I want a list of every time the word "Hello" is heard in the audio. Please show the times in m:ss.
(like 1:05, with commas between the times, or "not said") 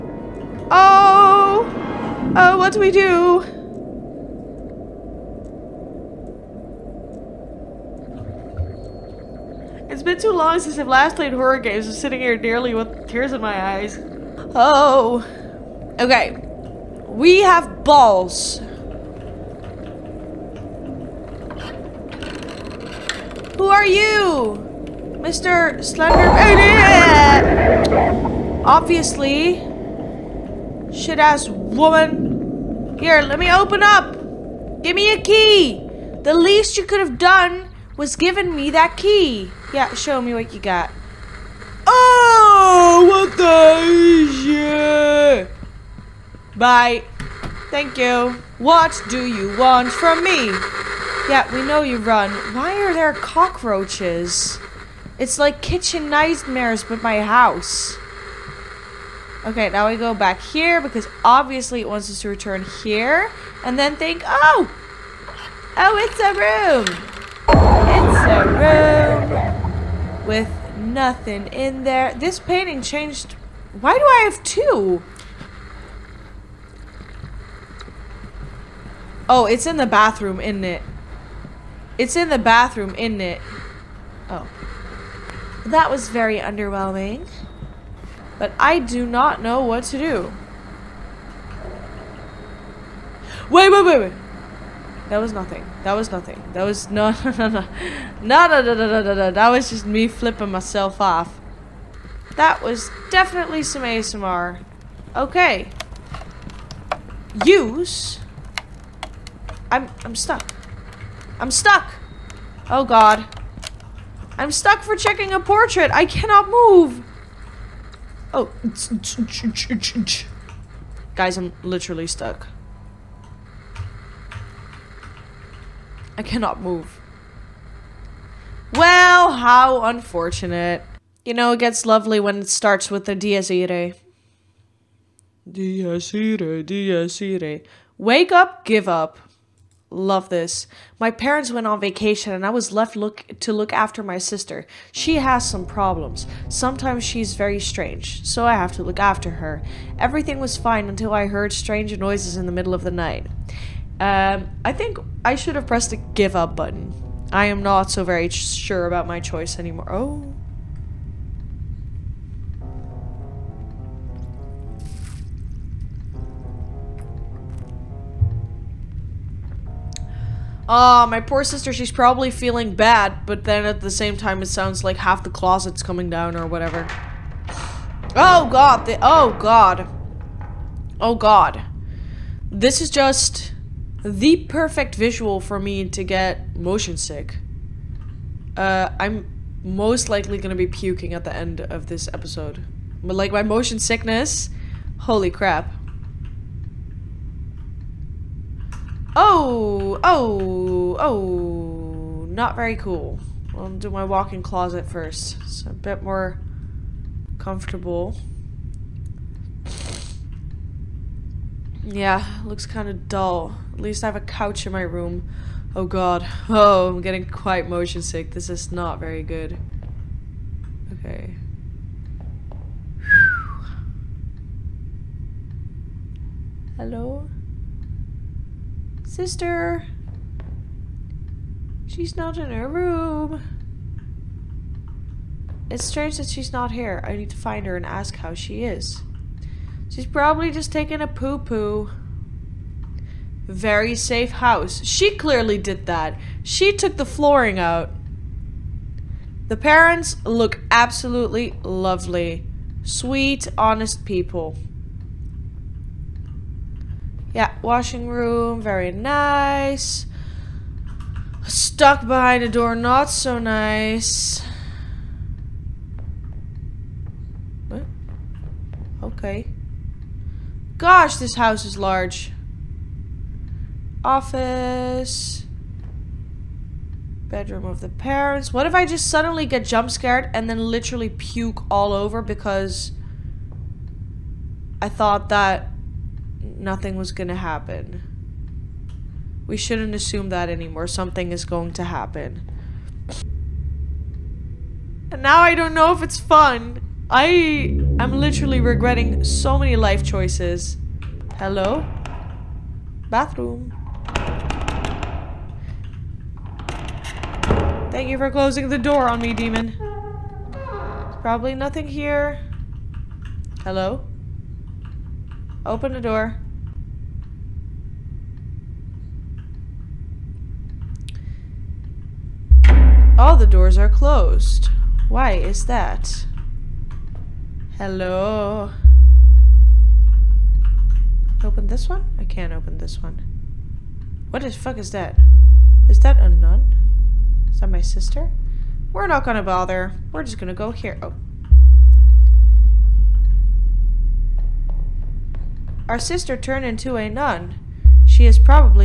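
3:46, 5:01, 5:13, 5:27.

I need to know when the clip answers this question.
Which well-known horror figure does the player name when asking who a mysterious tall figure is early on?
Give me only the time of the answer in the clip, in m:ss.
0:25.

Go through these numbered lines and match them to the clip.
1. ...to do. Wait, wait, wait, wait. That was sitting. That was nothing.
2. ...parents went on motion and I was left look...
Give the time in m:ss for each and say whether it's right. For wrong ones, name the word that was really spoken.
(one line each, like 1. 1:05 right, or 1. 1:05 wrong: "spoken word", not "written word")
1. 1:29 wrong: "nothing", not "sitting"
2. 2:21 wrong: "vacation", not "motion".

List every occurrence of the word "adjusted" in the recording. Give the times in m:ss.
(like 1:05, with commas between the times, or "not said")
not said.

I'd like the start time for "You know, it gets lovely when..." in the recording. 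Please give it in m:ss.
2:11.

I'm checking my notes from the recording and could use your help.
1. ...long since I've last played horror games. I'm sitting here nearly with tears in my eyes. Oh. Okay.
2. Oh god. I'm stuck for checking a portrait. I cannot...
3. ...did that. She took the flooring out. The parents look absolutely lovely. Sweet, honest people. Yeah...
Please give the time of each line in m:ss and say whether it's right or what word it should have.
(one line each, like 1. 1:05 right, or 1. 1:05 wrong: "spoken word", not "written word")
1. 0:10 right
2. 1:52 right
3. 4:05 right.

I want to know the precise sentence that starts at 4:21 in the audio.
Stuck behind a door, not so nice.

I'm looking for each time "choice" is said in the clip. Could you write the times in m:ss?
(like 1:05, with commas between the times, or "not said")
2:39, 5:00.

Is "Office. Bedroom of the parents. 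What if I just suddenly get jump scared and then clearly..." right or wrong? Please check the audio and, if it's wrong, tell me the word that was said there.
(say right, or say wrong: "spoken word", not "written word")
wrong: "literally", not "clearly".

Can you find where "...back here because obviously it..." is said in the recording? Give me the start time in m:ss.
1:00.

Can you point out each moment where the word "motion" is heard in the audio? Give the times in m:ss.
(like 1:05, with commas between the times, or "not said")
3:06, 3:13, 3:37.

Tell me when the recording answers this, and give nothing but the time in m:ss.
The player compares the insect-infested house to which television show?
0:55.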